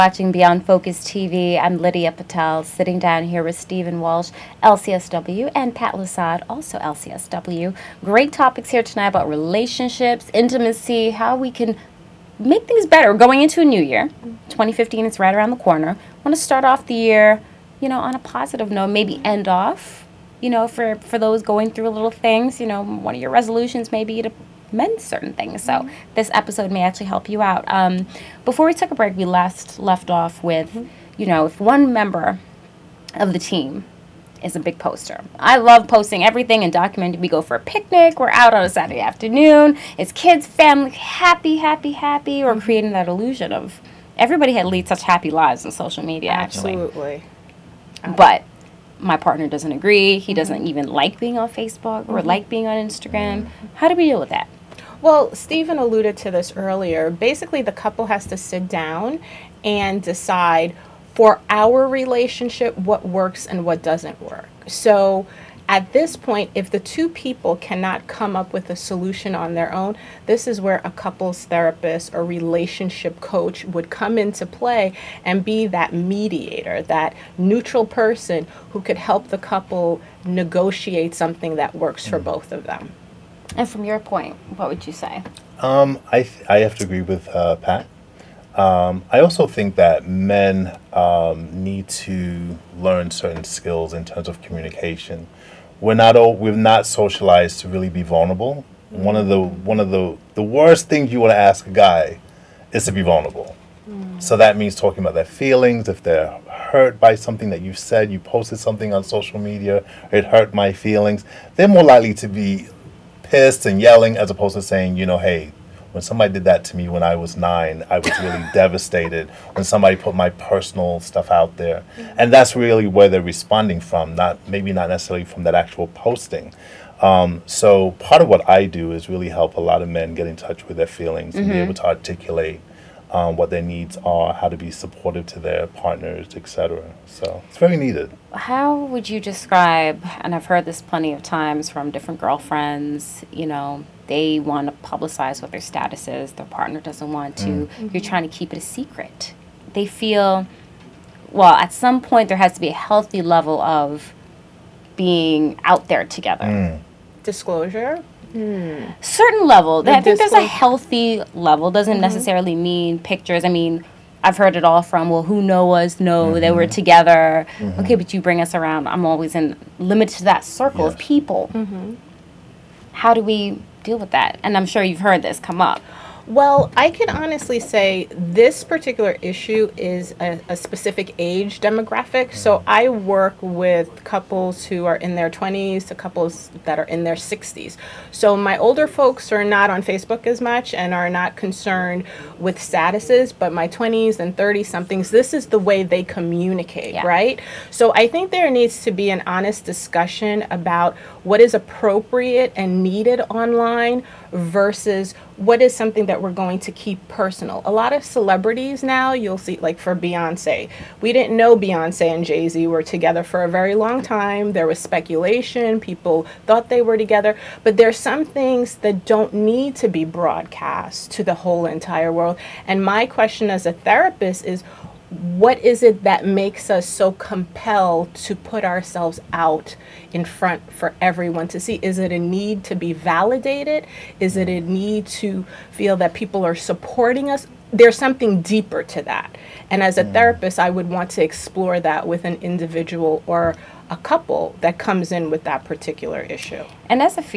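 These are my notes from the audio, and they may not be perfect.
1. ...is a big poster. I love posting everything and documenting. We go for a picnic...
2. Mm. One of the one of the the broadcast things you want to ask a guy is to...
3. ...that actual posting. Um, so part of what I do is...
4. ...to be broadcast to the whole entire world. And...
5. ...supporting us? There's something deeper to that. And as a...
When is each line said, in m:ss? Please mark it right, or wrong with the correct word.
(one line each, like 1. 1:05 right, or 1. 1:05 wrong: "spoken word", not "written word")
1. 0:34 right
2. 1:38 wrong: "worst", not "broadcast"
3. 2:05 right
4. 3:39 right
5. 3:56 right.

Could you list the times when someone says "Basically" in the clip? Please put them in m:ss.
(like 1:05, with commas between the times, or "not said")
0:57.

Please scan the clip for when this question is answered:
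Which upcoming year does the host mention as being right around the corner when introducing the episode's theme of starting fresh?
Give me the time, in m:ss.
0:14.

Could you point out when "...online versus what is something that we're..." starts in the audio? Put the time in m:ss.
3:23.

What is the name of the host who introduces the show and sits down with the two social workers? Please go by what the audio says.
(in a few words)
Lydia Patel.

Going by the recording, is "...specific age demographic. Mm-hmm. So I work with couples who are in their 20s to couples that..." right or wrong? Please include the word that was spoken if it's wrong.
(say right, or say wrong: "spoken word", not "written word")
right.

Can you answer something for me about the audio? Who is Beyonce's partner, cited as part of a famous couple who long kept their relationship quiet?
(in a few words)
Jay Z.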